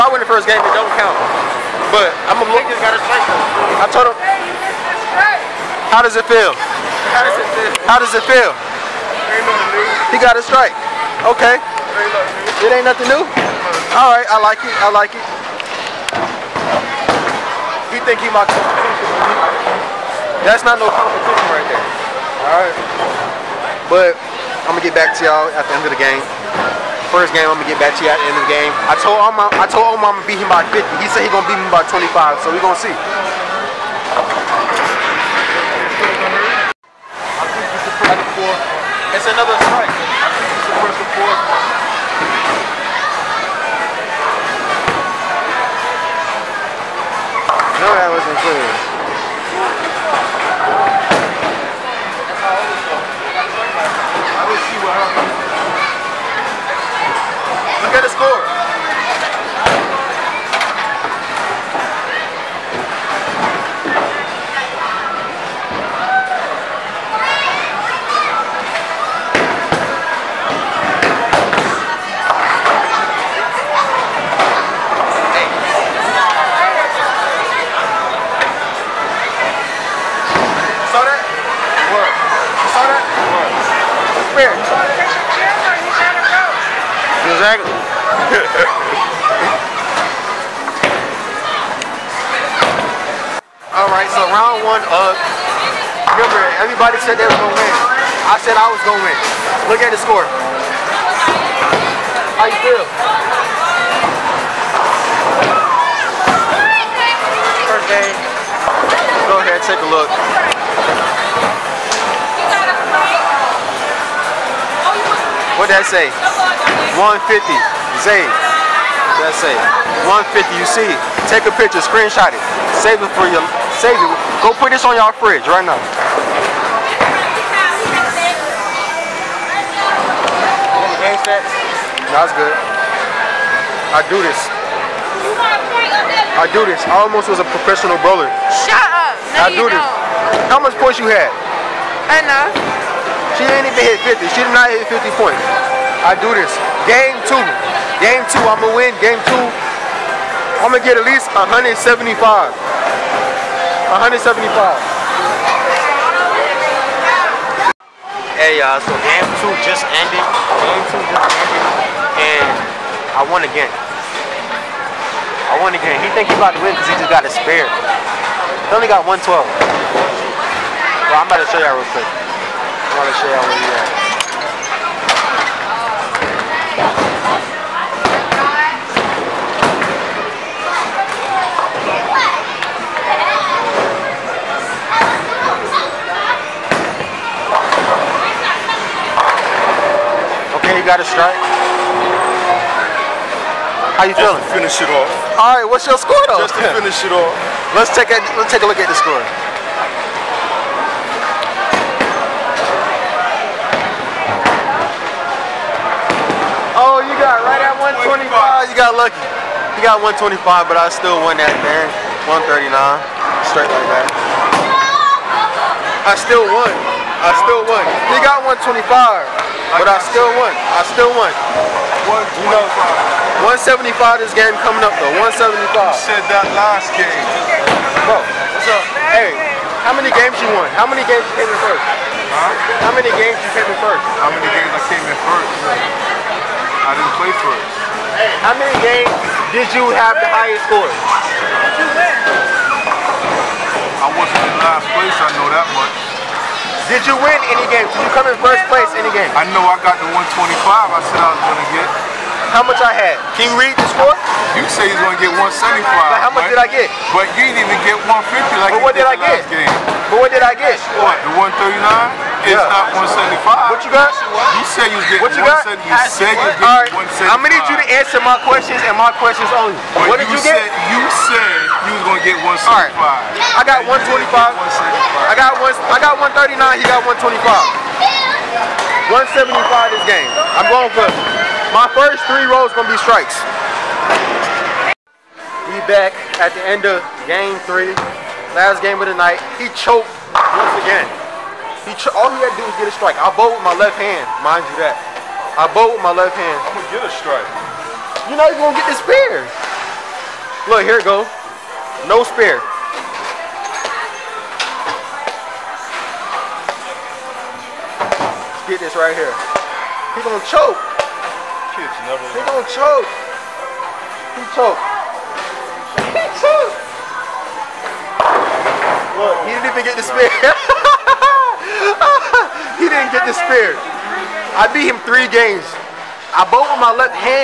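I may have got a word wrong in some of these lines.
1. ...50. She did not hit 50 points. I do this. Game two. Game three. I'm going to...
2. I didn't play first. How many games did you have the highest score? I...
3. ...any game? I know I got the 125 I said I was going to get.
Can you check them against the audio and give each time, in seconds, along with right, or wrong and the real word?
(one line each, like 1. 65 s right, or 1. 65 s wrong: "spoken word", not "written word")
1. 144 s wrong: "two", not "three"
2. 236 s right
3. 248 s right.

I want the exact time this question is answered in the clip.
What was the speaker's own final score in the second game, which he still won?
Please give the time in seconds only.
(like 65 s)
212 s.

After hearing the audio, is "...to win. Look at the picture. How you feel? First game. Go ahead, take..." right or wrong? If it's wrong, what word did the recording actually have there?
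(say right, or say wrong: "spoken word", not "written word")
wrong: "score", not "picture".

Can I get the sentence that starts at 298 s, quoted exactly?
You know you're gonna get this spear.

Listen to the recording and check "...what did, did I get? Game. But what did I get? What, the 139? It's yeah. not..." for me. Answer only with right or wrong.
right.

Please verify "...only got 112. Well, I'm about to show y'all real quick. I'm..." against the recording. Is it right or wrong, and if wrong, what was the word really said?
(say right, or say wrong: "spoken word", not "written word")
right.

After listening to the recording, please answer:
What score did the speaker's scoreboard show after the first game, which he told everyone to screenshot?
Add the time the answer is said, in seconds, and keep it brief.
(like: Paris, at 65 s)
150, at 115 s.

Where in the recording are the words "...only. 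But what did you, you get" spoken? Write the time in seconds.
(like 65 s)
269 s.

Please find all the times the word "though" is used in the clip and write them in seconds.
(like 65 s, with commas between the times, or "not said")
196 s, 225 s.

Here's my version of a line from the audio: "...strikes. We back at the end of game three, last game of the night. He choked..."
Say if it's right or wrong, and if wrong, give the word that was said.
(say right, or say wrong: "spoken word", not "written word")
right.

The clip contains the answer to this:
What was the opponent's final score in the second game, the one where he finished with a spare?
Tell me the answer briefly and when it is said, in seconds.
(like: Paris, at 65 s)
125, at 206 s.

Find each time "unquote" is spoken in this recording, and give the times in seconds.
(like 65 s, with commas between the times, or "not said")
not said.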